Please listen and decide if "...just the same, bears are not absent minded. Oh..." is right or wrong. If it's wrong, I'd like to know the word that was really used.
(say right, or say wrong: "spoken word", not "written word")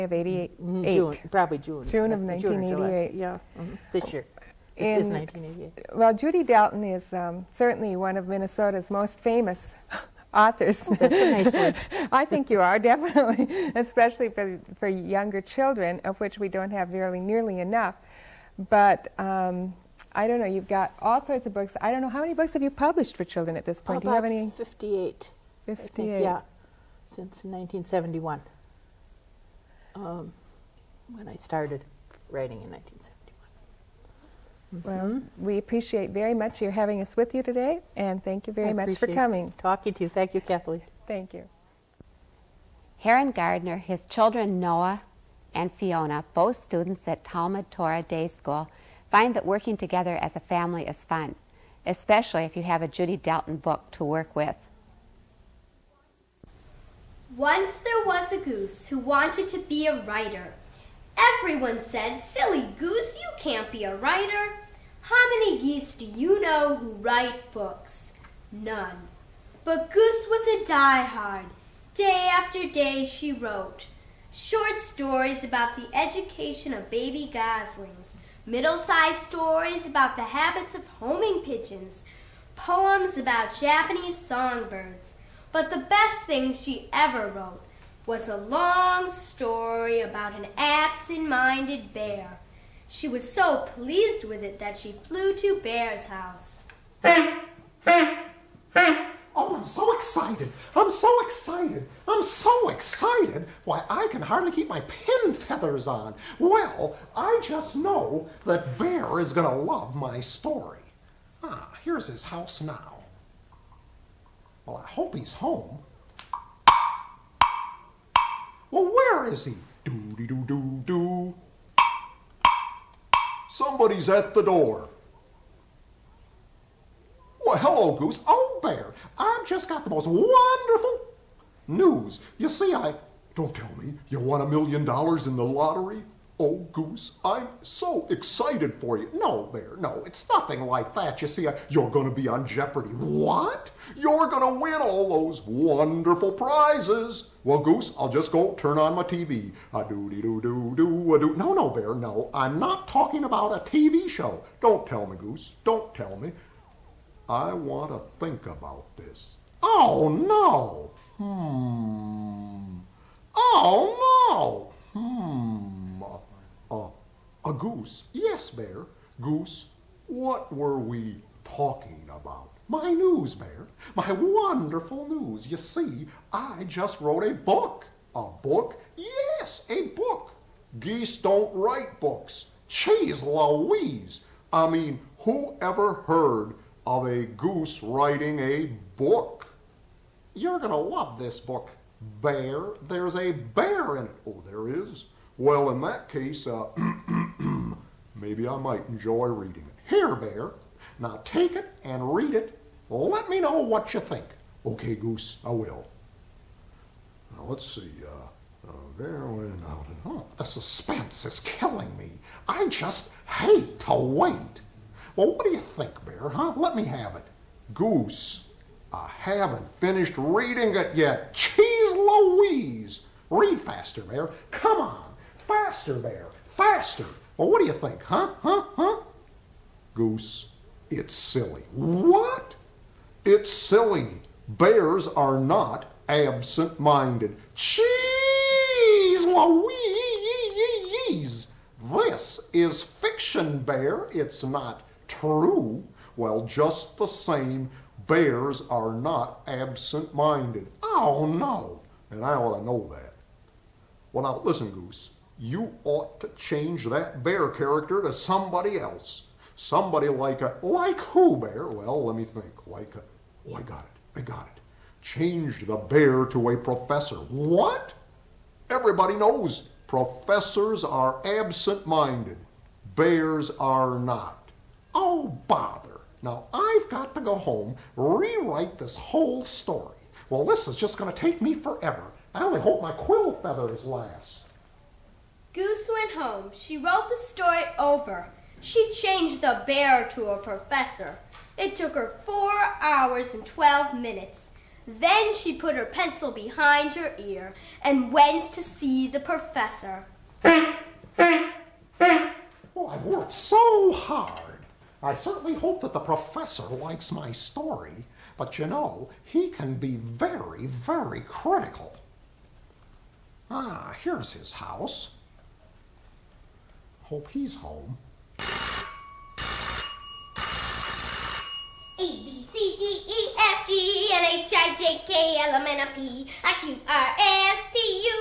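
right.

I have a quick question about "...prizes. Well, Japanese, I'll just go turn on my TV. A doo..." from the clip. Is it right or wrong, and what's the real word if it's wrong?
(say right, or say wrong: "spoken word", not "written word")
wrong: "Goose", not "Japanese".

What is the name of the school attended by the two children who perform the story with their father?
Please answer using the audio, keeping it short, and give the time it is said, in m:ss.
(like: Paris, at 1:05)
Talmud Torah Day School, at 0:47.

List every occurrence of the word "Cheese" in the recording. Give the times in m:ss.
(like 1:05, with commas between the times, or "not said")
3:02, 3:41, 3:57.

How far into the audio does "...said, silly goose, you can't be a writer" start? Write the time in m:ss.
1:01.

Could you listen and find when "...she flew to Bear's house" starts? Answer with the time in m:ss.
1:34.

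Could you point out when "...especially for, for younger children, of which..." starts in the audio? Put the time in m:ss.
0:13.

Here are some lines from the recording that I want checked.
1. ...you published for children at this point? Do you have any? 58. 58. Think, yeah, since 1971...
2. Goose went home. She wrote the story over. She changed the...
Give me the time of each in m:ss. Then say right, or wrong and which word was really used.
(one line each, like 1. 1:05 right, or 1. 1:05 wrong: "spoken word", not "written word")
1. 0:22 right
2. 4:45 right.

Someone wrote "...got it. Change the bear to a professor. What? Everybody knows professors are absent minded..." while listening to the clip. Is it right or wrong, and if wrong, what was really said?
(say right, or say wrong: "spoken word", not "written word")
right.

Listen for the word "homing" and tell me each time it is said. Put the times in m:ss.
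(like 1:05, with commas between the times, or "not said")
1:20.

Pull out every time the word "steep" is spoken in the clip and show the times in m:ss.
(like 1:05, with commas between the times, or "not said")
not said.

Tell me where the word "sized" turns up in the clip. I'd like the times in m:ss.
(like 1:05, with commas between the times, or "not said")
1:18.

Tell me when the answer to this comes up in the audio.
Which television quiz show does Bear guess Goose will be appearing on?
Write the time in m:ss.
2:22.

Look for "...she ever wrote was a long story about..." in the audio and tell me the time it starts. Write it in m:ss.
1:26.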